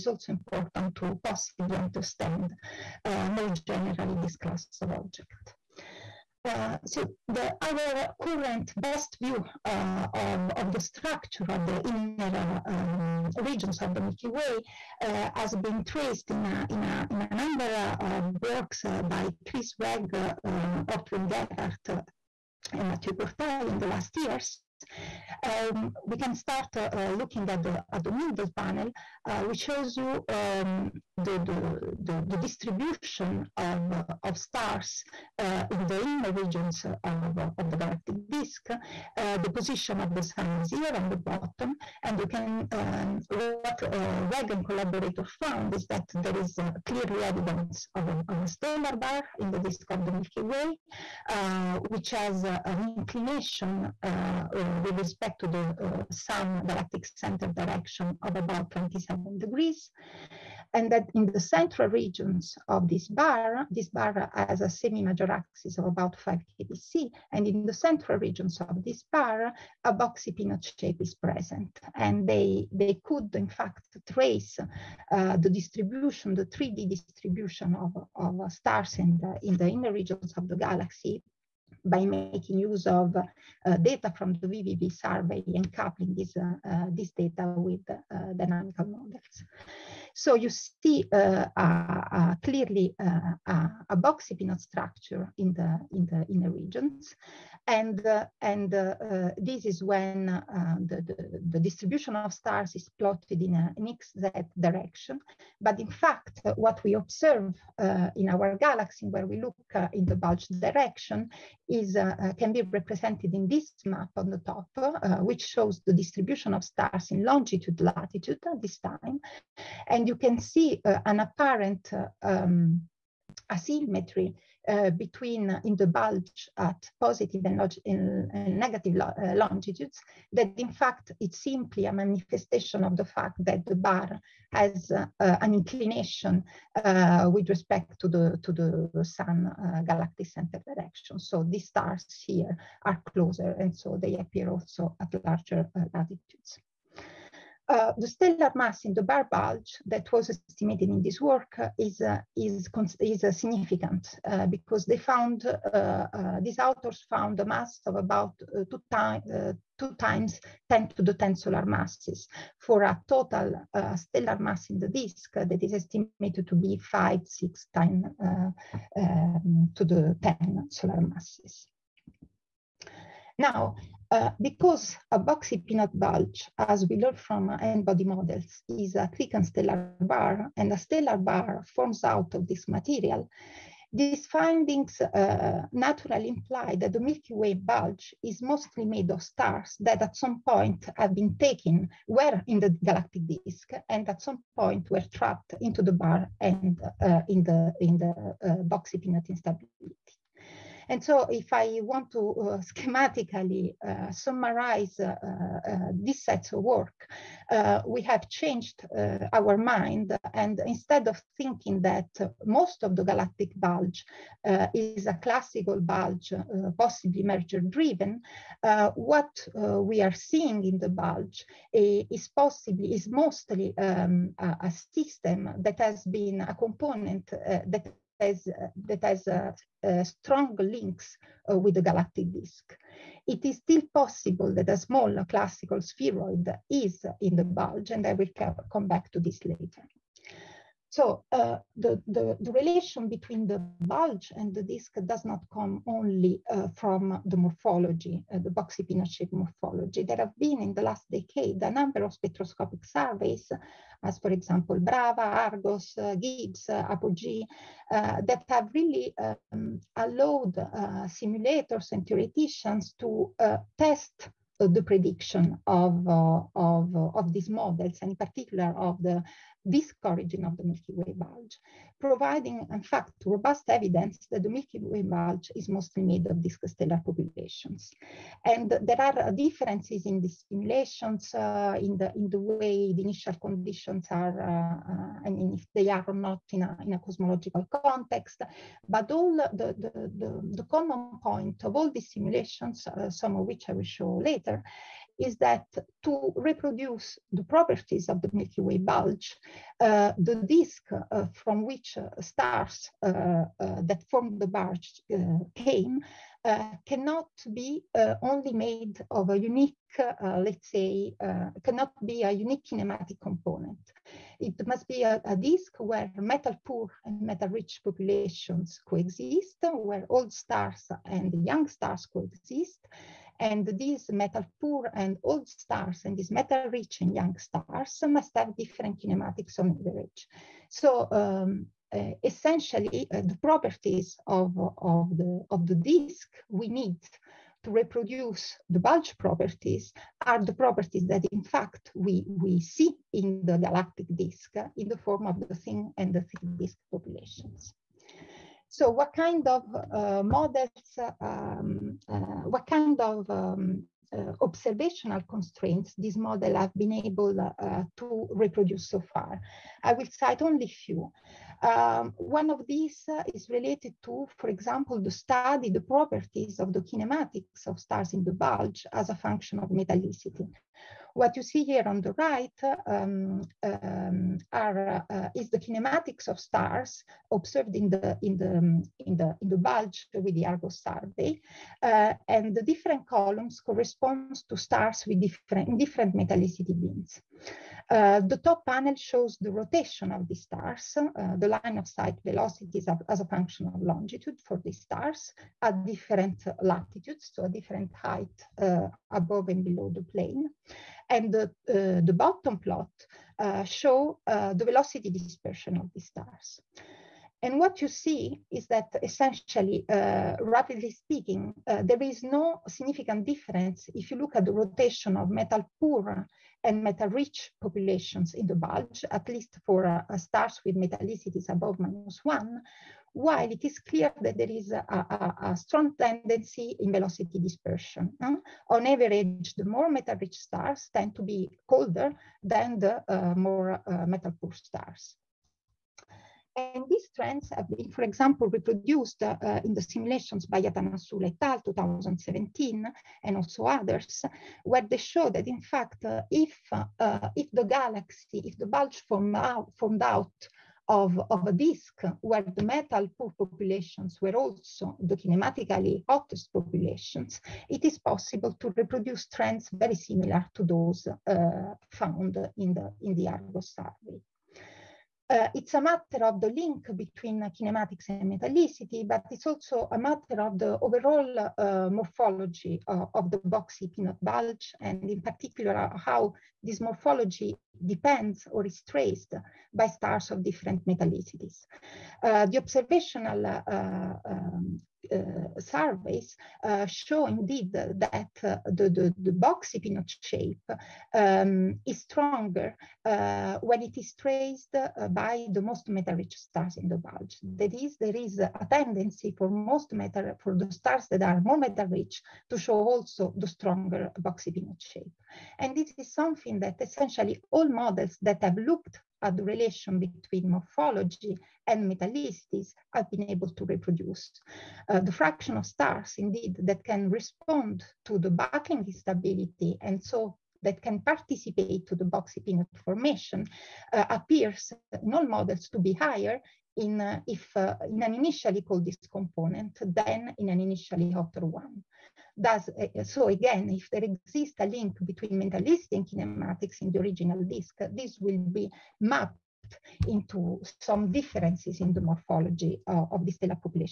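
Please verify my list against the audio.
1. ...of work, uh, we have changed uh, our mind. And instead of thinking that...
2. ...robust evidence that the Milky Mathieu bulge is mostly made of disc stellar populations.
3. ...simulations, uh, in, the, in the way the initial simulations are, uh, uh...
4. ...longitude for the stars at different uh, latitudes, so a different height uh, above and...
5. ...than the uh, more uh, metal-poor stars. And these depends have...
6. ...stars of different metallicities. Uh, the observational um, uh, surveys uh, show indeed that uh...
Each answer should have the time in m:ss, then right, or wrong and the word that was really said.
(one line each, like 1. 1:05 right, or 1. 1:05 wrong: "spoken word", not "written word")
1. 3:26 right
2. 4:33 wrong: "Way", not "Mathieu"
3. 4:40 wrong: "conditions", not "simulations"
4. 6:33 right
5. 7:12 wrong: "trends", not "depends"
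6. 7:59 right.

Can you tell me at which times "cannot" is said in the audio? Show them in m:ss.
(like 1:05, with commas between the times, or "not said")
5:06, 5:11.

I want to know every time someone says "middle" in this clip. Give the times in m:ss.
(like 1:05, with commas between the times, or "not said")
0:28.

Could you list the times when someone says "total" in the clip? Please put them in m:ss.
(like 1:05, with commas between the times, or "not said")
2:43.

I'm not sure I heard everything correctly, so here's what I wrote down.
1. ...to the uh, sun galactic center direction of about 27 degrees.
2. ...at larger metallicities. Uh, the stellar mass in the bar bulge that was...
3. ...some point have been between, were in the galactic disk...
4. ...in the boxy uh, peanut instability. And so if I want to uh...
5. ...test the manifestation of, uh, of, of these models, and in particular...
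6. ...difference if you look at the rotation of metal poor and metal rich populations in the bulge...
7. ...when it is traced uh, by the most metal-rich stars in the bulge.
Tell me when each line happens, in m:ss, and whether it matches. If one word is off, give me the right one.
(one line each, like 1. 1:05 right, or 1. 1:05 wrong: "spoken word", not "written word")
1. 0:55 right
2. 2:24 wrong: "latitudes", not "metallicities"
3. 3:10 wrong: "taken", not "between"
4. 3:17 right
5. 4:23 wrong: "prediction", not "manifestation"
6. 6:53 right
7. 8:13 right.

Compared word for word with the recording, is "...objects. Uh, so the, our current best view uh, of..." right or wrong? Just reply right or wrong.
right.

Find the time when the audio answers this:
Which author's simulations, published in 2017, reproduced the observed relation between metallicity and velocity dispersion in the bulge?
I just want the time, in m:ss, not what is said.
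7:20.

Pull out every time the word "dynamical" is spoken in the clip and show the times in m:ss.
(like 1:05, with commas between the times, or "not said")
1:28.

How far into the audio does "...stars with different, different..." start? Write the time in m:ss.
6:24.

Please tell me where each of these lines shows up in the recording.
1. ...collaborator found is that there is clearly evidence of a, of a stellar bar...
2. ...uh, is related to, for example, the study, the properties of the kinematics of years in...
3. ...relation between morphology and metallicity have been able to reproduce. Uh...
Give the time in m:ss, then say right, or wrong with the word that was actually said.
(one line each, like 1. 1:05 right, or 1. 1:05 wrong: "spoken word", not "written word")
1. 0:44 right
2. 6:03 wrong: "stars", not "years"
3. 8:29 right.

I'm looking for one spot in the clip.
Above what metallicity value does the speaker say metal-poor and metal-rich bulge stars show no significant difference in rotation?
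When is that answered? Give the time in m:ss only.
7:01.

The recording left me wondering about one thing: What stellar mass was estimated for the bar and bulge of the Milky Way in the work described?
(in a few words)
2 × 10^10 solar masses.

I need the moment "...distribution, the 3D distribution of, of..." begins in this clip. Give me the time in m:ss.
1:15.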